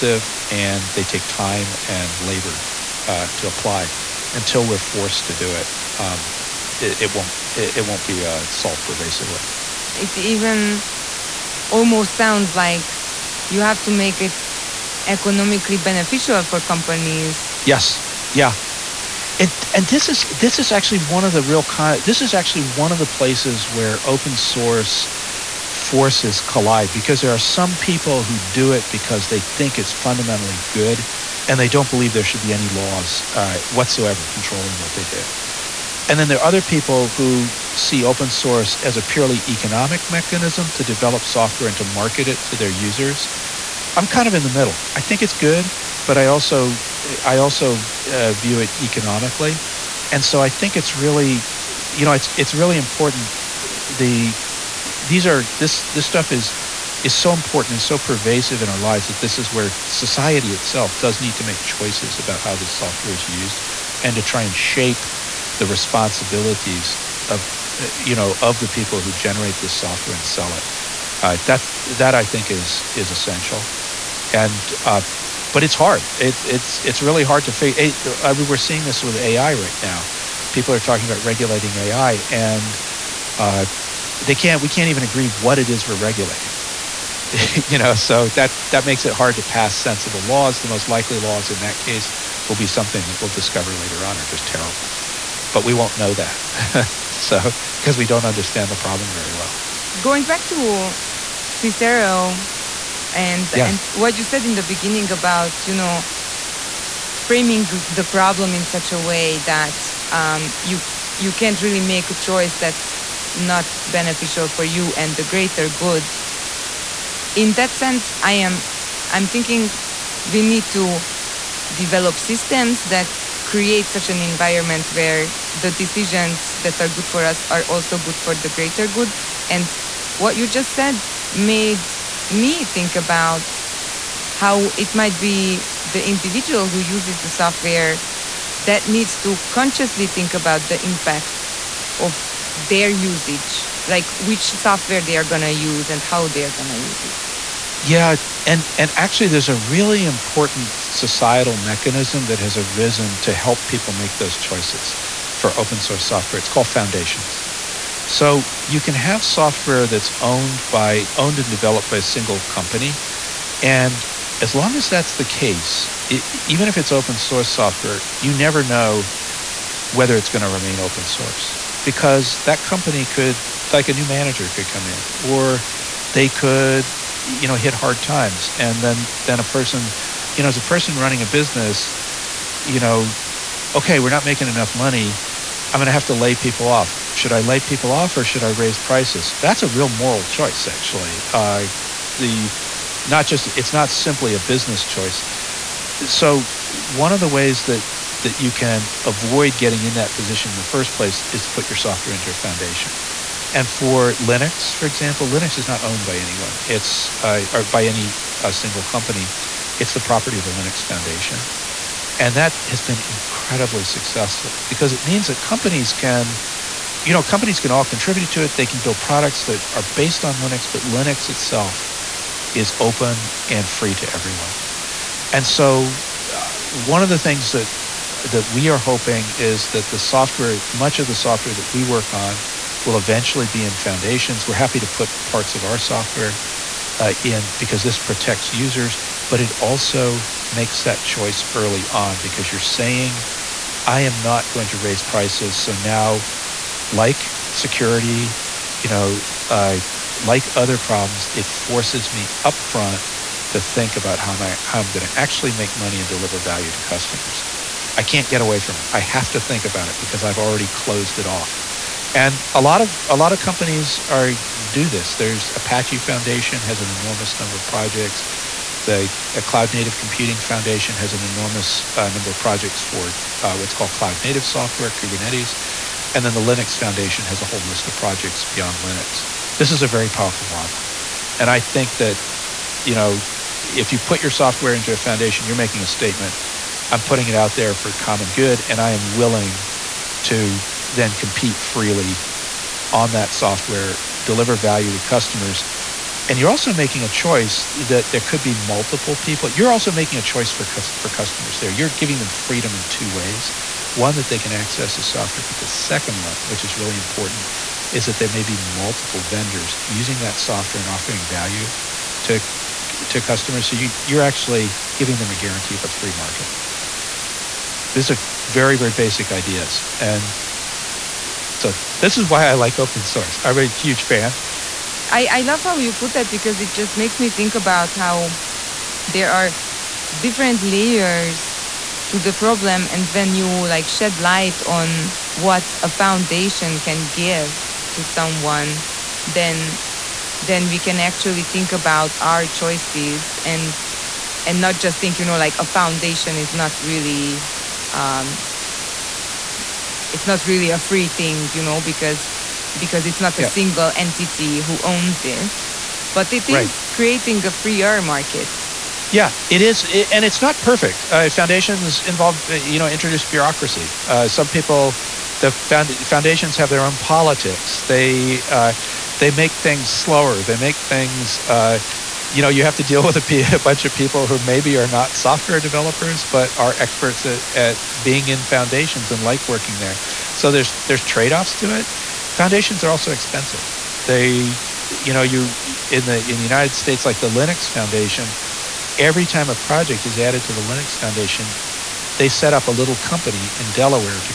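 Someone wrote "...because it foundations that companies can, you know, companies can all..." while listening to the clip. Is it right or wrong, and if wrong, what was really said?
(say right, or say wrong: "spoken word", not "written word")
wrong: "means", not "foundations".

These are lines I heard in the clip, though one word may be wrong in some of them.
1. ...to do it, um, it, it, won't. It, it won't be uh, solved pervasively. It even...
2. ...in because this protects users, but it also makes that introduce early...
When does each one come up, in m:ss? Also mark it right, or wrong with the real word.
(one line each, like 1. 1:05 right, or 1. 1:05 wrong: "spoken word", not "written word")
1. 0:05 right
2. 3:57 wrong: "choice", not "introduce".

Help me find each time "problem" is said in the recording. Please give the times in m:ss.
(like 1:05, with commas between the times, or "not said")
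1:38, 1:48, 4:10, 5:32.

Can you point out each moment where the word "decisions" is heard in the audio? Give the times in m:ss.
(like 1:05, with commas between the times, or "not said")
2:05.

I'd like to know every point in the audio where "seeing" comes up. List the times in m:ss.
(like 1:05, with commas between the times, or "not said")
1:18.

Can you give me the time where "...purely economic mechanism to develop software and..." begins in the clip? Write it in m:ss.
0:39.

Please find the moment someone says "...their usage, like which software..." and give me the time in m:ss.
2:22.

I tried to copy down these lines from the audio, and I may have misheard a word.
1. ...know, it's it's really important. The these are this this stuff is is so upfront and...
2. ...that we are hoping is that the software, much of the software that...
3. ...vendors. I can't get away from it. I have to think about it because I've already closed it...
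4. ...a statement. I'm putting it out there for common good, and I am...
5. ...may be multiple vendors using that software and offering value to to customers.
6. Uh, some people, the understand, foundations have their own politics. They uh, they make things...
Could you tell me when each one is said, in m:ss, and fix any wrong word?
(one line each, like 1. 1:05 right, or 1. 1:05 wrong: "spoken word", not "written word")
1. 0:52 wrong: "important", not "upfront"
2. 3:48 right
3. 4:16 wrong: "customers", not "vendors"
4. 4:45 right
5. 5:08 right
6. 6:04 wrong: "found", not "understand".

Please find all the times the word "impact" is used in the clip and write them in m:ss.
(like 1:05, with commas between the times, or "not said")
2:20.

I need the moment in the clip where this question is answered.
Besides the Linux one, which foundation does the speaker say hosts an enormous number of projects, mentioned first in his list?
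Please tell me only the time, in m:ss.
4:25.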